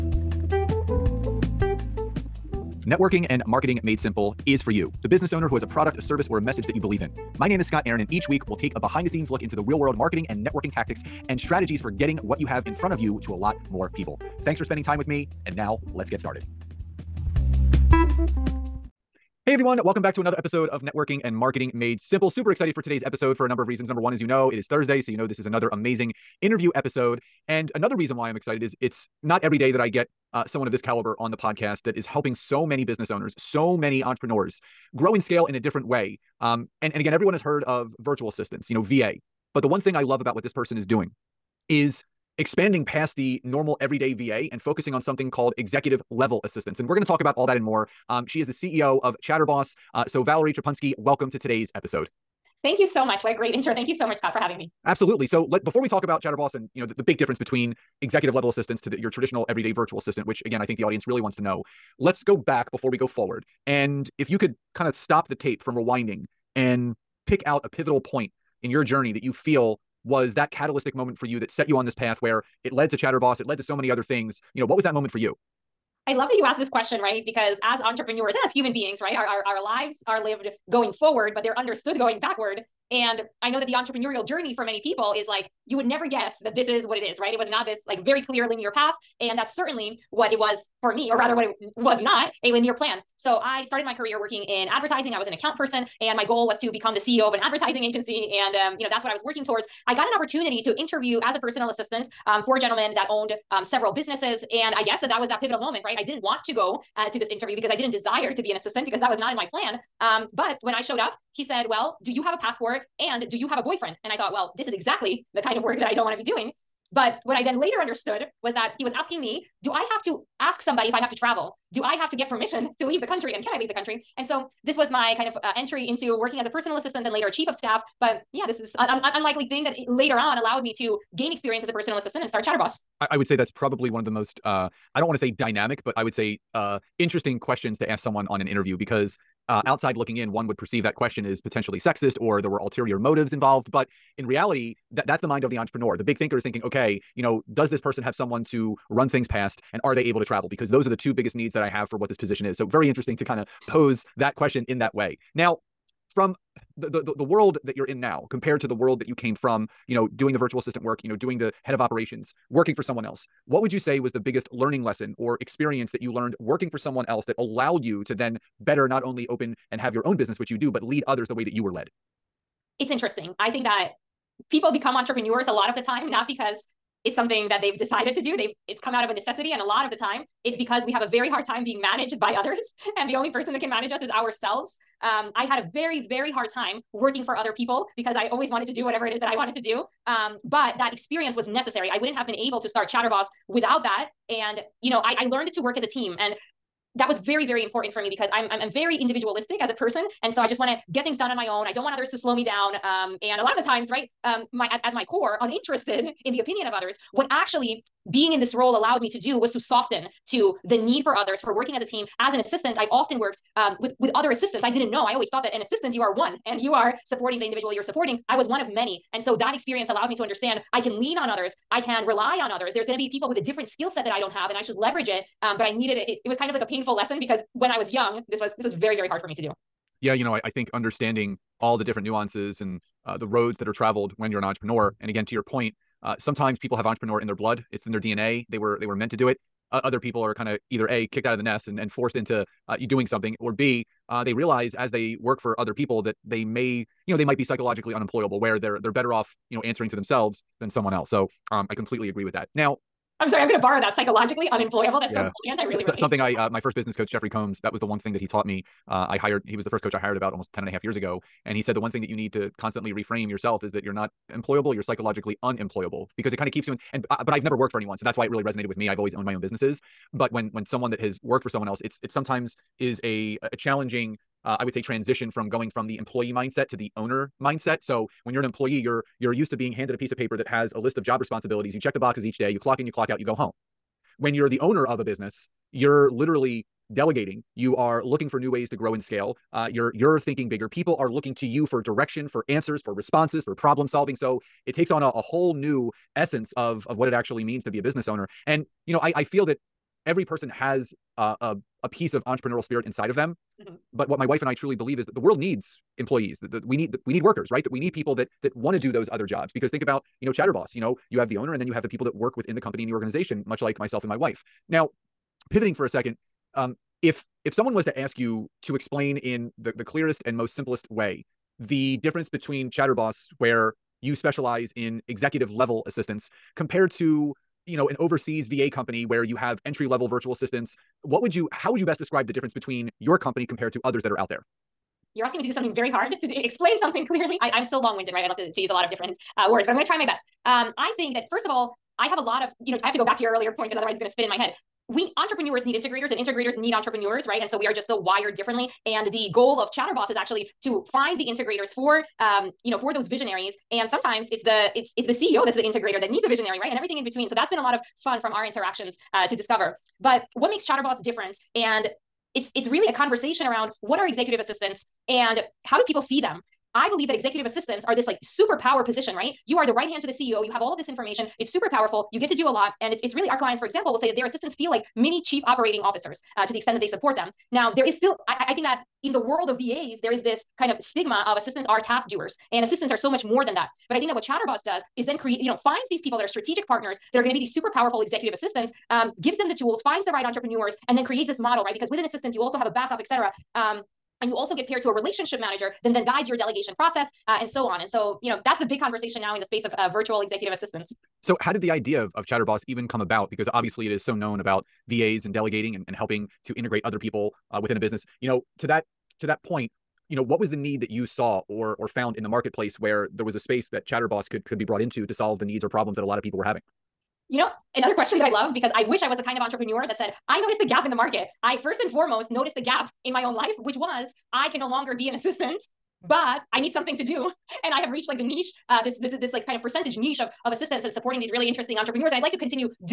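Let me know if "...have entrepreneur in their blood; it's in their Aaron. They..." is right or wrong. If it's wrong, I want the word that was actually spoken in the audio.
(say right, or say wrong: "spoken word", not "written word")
wrong: "DNA", not "Aaron".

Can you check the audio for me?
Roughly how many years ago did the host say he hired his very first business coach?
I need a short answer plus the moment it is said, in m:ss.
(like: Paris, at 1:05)
10 and a half years, at 4:20.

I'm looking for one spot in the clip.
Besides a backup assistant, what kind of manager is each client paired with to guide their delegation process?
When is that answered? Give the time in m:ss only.
6:34.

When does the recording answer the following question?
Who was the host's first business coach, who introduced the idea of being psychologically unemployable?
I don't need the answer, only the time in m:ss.
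4:17.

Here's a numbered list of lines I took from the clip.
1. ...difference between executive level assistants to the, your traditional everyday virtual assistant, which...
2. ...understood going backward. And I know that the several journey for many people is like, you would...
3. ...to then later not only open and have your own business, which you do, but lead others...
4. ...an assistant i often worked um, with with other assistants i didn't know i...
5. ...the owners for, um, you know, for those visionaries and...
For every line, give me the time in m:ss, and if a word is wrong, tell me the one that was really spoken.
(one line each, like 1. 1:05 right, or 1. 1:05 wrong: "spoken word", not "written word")
1. 0:57 right
2. 1:21 wrong: "entrepreneurial", not "several"
3. 2:48 wrong: "better", not "later"
4. 3:32 right
5. 5:51 wrong: "integrators", not "owners".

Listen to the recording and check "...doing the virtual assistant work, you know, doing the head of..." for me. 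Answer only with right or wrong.
right.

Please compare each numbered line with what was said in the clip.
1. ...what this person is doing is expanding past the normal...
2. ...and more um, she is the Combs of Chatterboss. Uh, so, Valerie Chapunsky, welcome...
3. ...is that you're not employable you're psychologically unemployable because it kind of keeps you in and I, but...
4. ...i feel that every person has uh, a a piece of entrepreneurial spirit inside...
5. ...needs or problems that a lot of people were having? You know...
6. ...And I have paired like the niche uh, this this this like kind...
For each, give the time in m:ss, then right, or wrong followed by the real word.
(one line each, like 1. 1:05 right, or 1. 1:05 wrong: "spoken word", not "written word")
1. 0:40 right
2. 0:47 wrong: "CEO", not "Combs"
3. 4:23 right
4. 4:59 right
5. 6:55 right
6. 7:07 wrong: "reached", not "paired".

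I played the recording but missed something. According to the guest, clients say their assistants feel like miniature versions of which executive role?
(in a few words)
Chief operating officers.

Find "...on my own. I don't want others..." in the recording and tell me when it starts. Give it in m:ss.
3:21.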